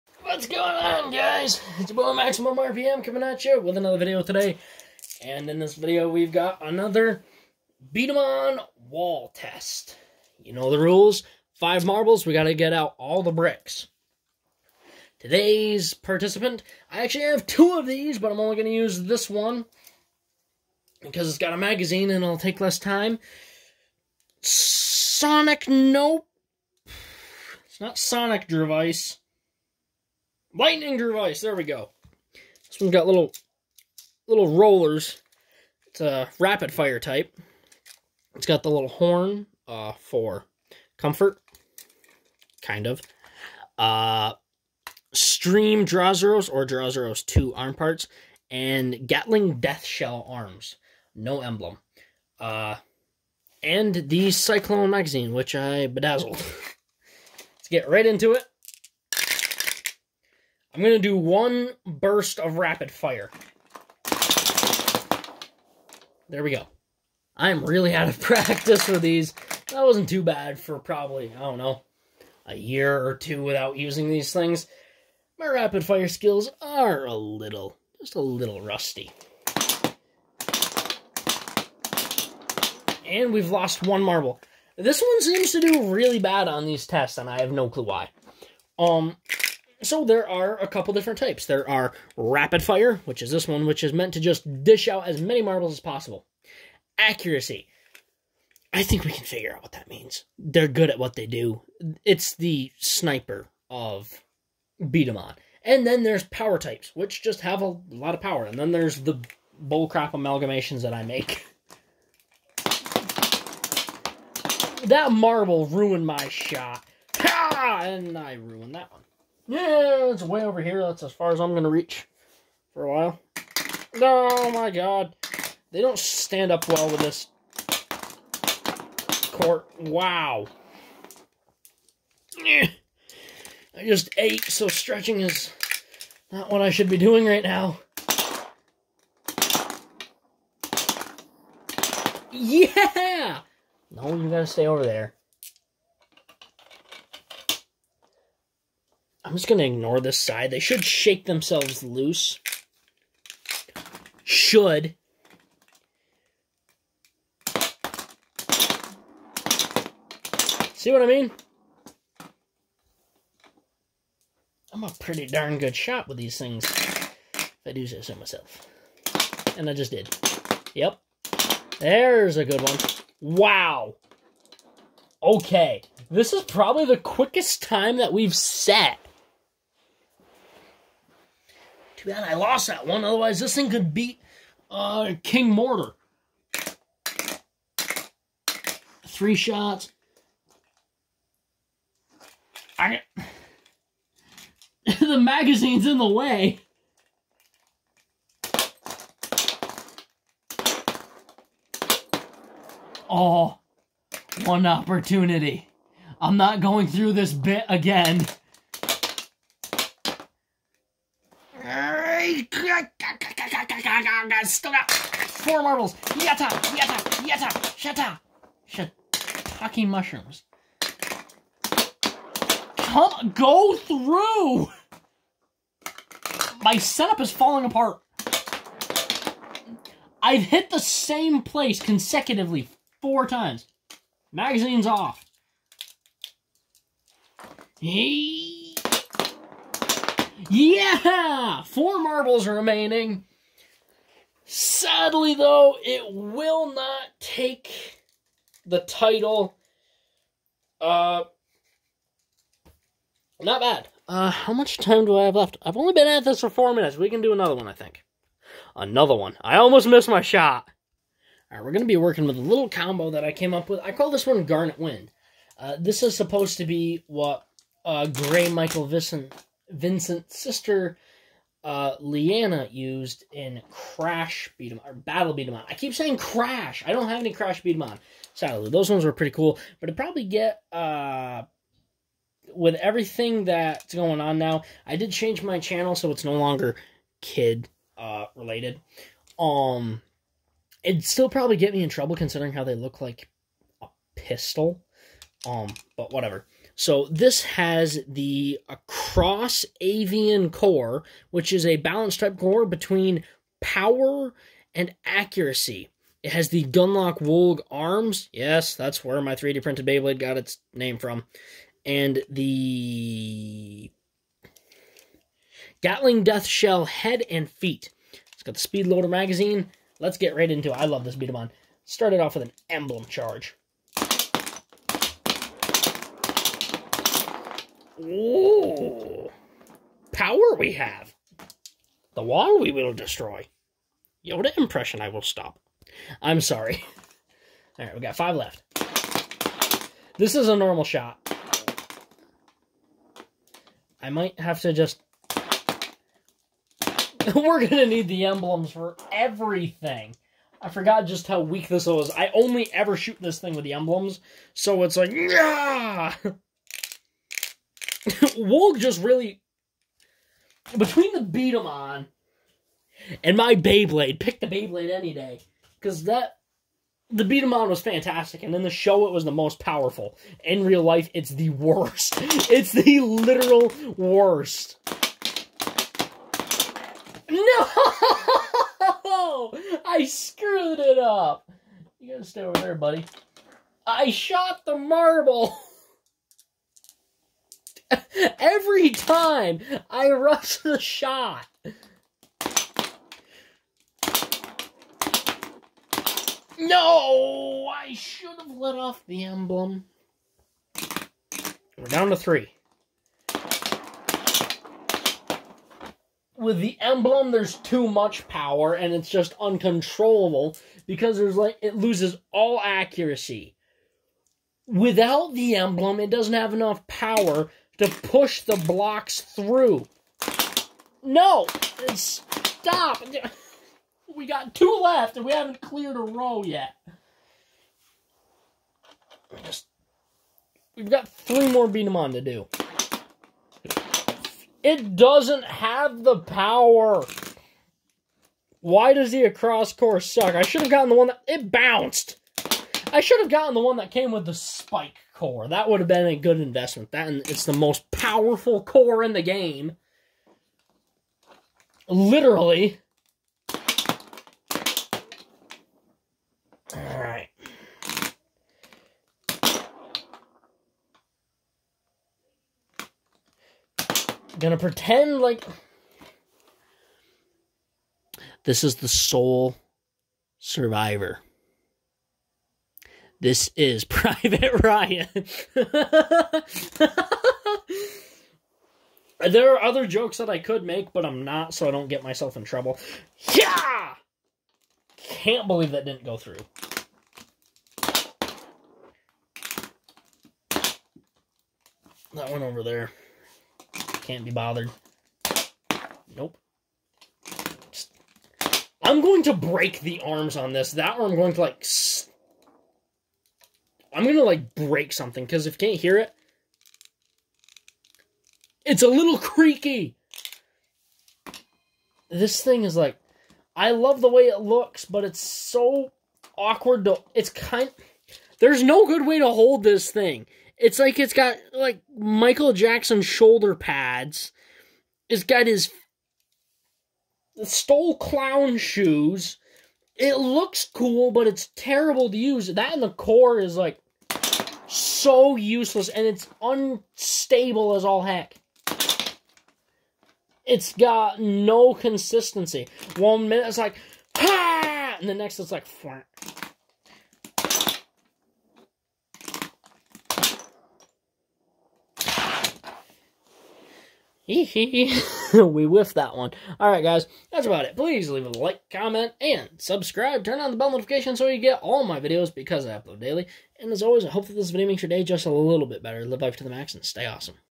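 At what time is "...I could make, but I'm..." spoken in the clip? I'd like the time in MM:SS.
08:00.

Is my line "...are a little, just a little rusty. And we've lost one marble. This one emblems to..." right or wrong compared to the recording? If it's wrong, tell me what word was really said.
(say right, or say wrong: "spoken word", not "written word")
wrong: "seems", not "emblems".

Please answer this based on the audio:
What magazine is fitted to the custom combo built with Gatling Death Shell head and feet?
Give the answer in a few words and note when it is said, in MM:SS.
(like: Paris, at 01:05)
Speed Loader, at 05:18.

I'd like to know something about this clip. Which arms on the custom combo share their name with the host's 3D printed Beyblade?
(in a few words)
Gunlock Wolg.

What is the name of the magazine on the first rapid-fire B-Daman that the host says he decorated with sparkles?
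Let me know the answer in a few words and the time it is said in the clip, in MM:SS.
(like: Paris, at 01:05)
Cyclone magazine, at 00:54.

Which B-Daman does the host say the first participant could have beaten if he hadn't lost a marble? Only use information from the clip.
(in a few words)
King Mortar.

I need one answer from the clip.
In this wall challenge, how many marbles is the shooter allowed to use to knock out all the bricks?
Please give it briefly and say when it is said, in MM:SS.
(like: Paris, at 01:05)
5, at 00:11.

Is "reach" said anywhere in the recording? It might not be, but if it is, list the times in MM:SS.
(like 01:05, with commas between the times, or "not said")
02:01.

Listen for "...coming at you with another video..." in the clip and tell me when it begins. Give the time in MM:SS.
00:03.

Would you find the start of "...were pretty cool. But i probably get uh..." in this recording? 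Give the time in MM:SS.
04:39.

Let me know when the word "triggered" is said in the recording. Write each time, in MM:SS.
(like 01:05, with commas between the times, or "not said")
not said.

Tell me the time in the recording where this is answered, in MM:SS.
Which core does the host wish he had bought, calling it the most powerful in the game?
07:24.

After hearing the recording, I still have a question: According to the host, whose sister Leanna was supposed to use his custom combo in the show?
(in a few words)
Gray Michael Visson Vincent.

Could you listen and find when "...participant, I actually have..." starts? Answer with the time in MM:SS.
00:15.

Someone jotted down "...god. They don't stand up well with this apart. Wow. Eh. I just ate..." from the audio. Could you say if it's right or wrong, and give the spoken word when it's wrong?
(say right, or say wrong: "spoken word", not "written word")
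wrong: "court", not "apart".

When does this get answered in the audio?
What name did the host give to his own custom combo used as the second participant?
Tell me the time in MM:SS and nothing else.
04:24.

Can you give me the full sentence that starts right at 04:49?
Um, it'd still probably get me in trouble considering how they look like a pistol.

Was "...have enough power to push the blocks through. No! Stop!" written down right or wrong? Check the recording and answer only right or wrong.
right.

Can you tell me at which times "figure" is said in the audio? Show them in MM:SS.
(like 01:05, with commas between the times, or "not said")
01:39.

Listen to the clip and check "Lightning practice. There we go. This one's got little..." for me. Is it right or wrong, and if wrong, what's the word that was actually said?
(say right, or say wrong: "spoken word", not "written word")
wrong: "device", not "practice".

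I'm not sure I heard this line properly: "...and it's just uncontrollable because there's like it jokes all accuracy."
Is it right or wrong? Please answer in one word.
wrong.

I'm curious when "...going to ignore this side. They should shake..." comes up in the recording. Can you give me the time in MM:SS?
02:29.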